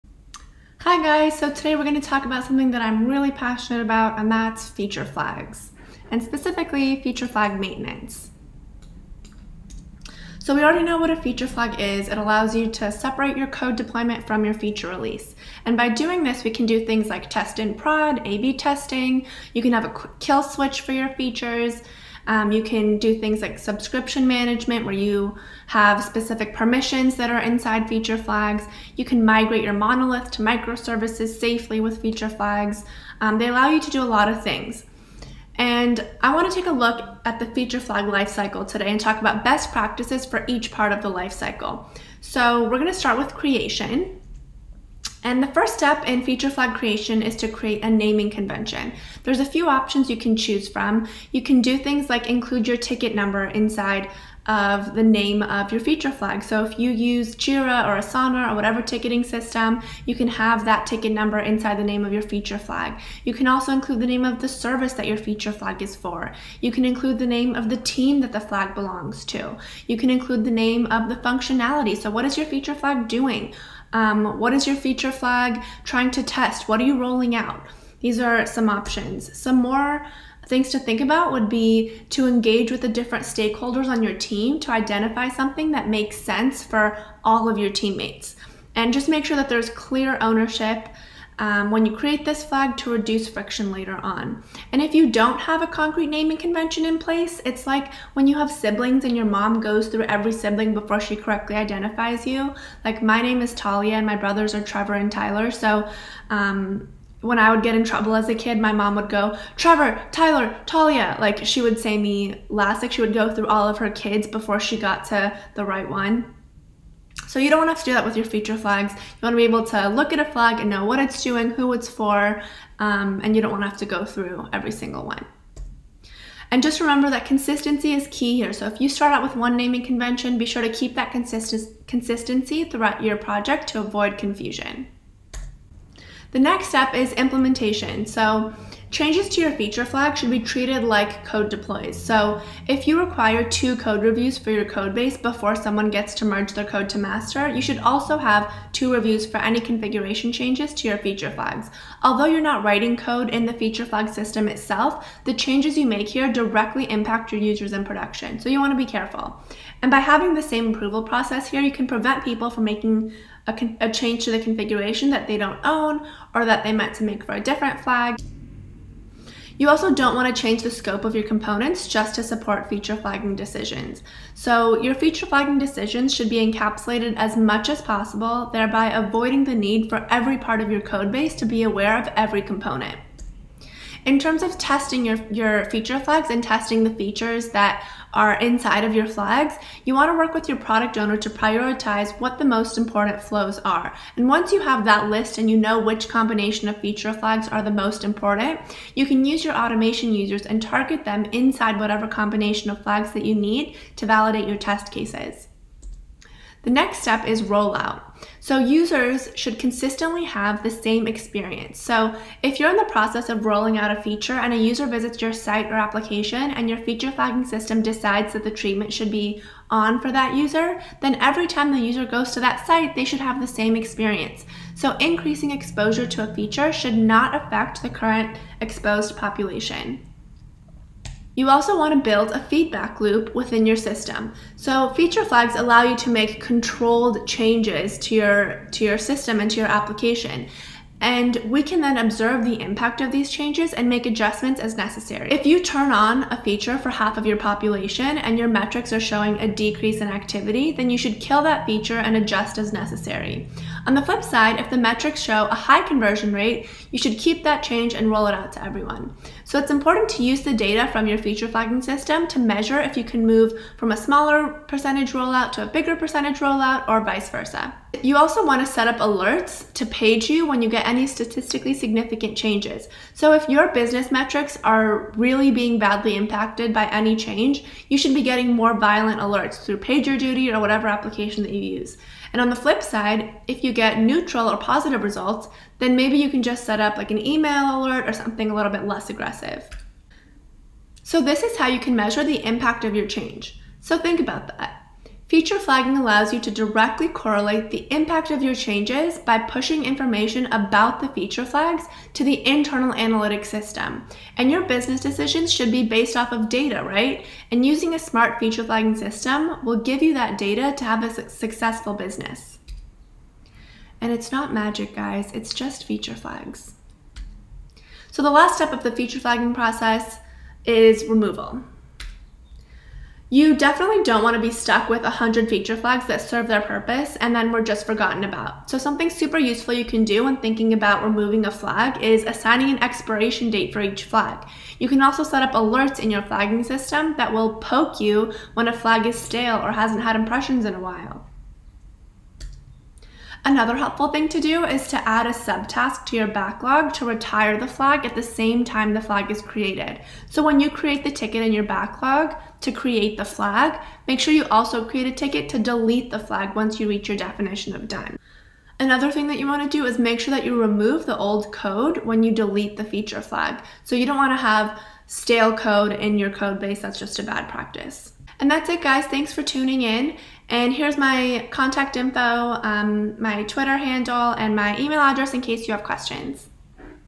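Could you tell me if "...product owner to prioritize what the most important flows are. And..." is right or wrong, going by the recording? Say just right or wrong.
right.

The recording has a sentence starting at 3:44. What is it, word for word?
So increasing exposure to a feature should not affect the current exposed population.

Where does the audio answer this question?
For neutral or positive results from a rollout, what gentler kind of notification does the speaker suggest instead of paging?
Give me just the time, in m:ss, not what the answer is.
4:47.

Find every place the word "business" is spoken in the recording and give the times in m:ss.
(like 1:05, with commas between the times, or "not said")
4:33, 5:04, 5:11.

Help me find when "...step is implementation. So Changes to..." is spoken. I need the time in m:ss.
2:16.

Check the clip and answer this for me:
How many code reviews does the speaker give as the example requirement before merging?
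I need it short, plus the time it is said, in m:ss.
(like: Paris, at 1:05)
2, at 2:23.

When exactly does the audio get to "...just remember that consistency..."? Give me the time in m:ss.
2:06.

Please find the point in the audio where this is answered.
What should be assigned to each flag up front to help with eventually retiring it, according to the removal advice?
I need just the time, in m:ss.
5:32.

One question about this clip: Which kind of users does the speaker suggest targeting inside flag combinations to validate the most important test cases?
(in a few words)
automation users.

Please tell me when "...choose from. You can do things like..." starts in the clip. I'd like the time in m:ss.
0:50.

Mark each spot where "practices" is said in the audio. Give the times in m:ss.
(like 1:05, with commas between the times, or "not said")
0:39, 6:07.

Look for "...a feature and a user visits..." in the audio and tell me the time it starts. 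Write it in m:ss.
3:33.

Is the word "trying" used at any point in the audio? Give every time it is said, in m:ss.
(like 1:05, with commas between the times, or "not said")
1:15.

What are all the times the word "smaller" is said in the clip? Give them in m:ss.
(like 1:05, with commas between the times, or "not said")
4:23.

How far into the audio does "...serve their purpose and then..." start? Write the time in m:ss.
5:26.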